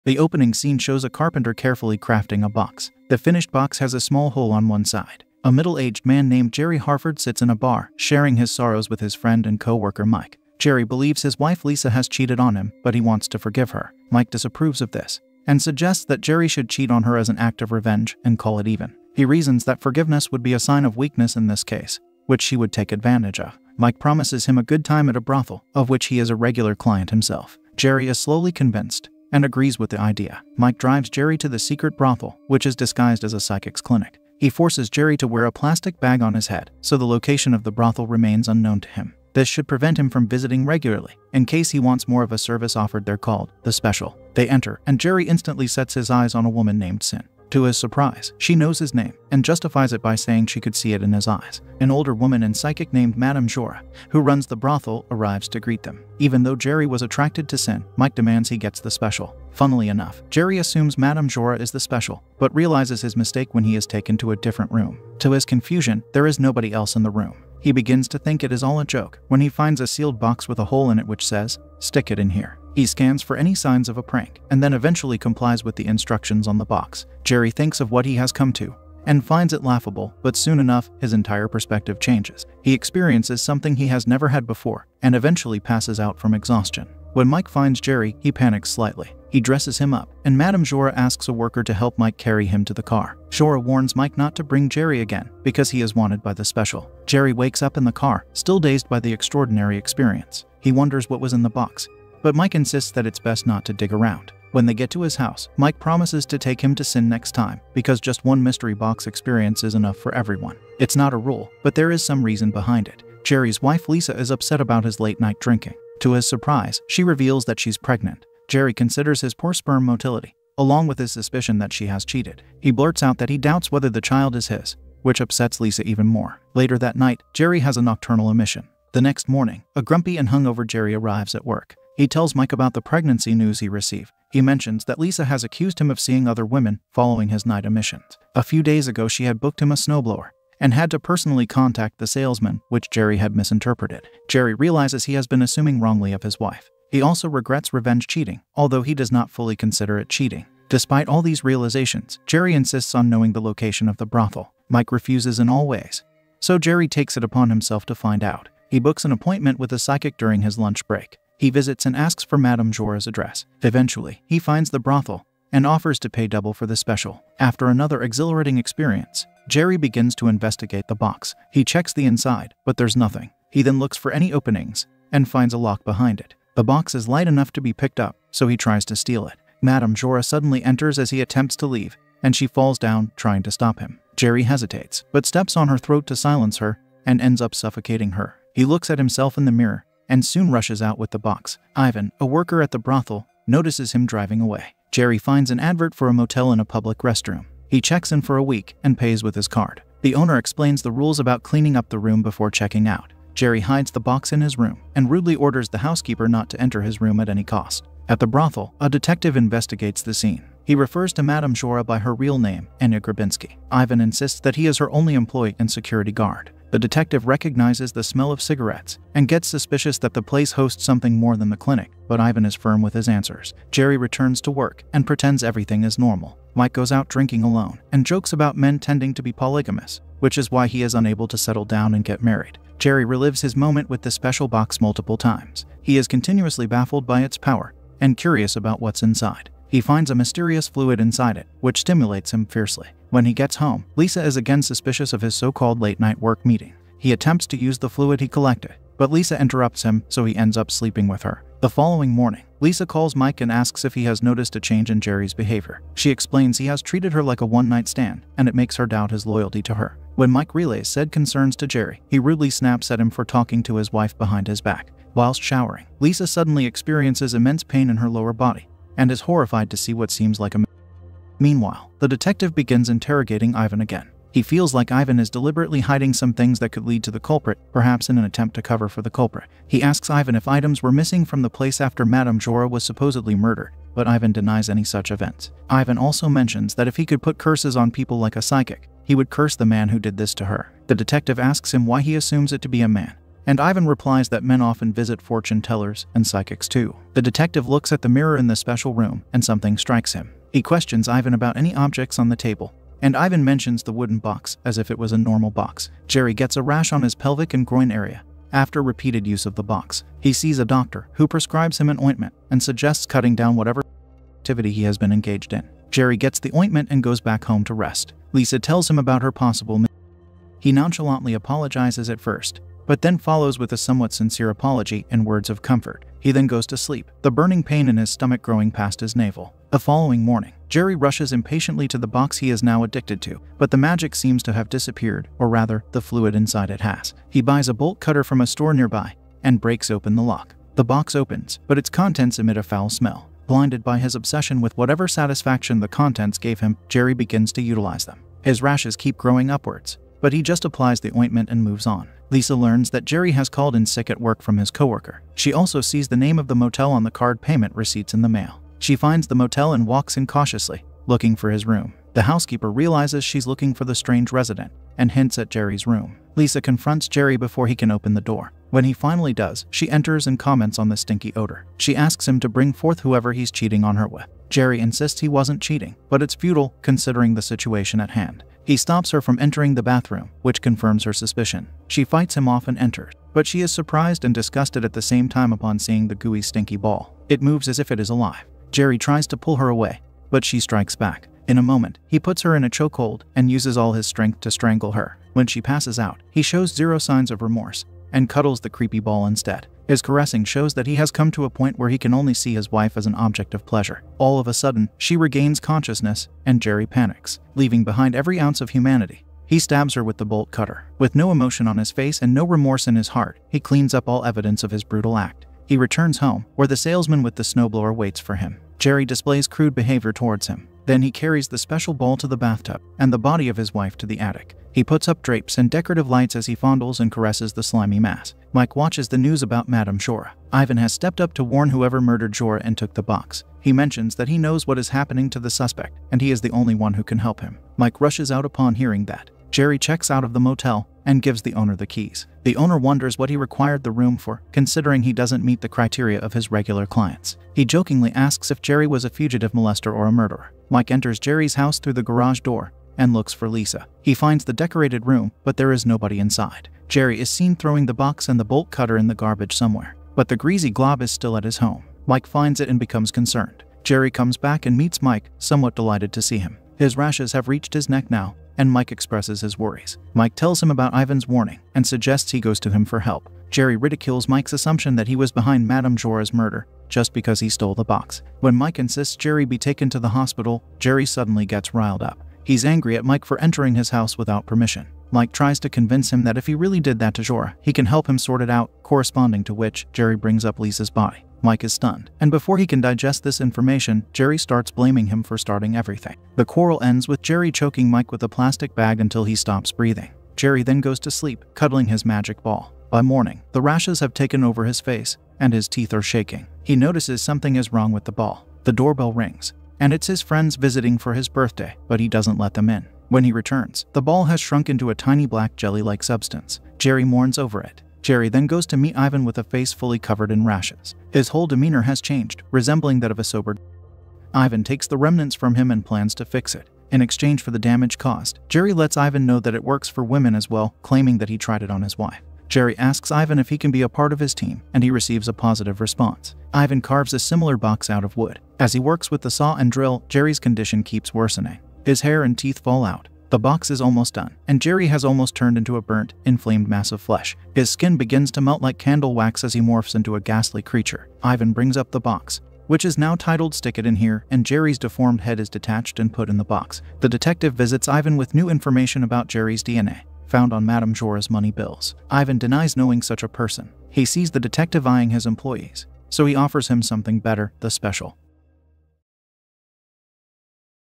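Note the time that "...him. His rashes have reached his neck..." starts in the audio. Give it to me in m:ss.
7:46.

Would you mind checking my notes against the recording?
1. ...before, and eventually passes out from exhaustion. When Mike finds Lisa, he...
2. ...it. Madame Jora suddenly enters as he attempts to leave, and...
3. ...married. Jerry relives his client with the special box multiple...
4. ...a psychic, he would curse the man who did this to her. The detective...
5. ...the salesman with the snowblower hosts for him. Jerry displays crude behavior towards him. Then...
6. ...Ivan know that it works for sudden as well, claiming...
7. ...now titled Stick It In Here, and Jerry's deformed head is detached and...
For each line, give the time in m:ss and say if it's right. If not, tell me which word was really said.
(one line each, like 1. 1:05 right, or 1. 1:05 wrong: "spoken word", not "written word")
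1. 1:24 wrong: "Jerry", not "Lisa"
2. 2:59 right
3. 3:52 wrong: "moment", not "client"
4. 4:48 right
5. 6:56 wrong: "waits", not "hosts"
6. 8:48 wrong: "women", not "sudden"
7. 9:12 right.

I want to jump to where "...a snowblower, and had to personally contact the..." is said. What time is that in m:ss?
2:19.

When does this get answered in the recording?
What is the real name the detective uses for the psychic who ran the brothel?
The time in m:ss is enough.
3:32.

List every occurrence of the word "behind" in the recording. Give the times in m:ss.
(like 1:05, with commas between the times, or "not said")
1:52, 2:55, 4:24, 6:47, 7:55.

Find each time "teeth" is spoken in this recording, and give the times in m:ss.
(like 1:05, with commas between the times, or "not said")
8:25, 9:02.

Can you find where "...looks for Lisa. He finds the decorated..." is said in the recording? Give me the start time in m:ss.
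7:33.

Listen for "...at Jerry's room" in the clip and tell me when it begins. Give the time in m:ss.
6:05.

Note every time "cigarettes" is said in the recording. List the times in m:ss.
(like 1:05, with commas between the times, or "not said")
3:38.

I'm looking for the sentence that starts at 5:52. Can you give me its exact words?
Lisa learns that Jerry has called in sick at work from his coworker.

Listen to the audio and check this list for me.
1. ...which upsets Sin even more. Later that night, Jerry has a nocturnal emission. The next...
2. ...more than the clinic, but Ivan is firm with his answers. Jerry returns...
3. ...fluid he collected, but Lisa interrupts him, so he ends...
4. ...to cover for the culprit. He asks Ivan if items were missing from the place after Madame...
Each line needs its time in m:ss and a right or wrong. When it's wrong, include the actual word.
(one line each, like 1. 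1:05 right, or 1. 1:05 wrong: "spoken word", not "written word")
1. 2:05 wrong: "Lisa", not "Sin"
2. 3:41 right
3. 4:07 right
4. 4:38 right.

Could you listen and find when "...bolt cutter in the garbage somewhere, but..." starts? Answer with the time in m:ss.
7:38.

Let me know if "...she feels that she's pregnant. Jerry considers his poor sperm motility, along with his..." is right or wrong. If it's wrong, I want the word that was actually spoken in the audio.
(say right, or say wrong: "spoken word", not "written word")
wrong: "reveals", not "feels".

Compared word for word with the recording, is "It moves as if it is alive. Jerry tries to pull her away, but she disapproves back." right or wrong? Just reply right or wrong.
wrong.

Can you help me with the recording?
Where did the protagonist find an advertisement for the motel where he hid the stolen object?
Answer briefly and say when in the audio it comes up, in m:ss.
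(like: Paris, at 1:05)
public restroom, at 3:16.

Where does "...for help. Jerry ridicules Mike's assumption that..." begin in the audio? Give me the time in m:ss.
7:52.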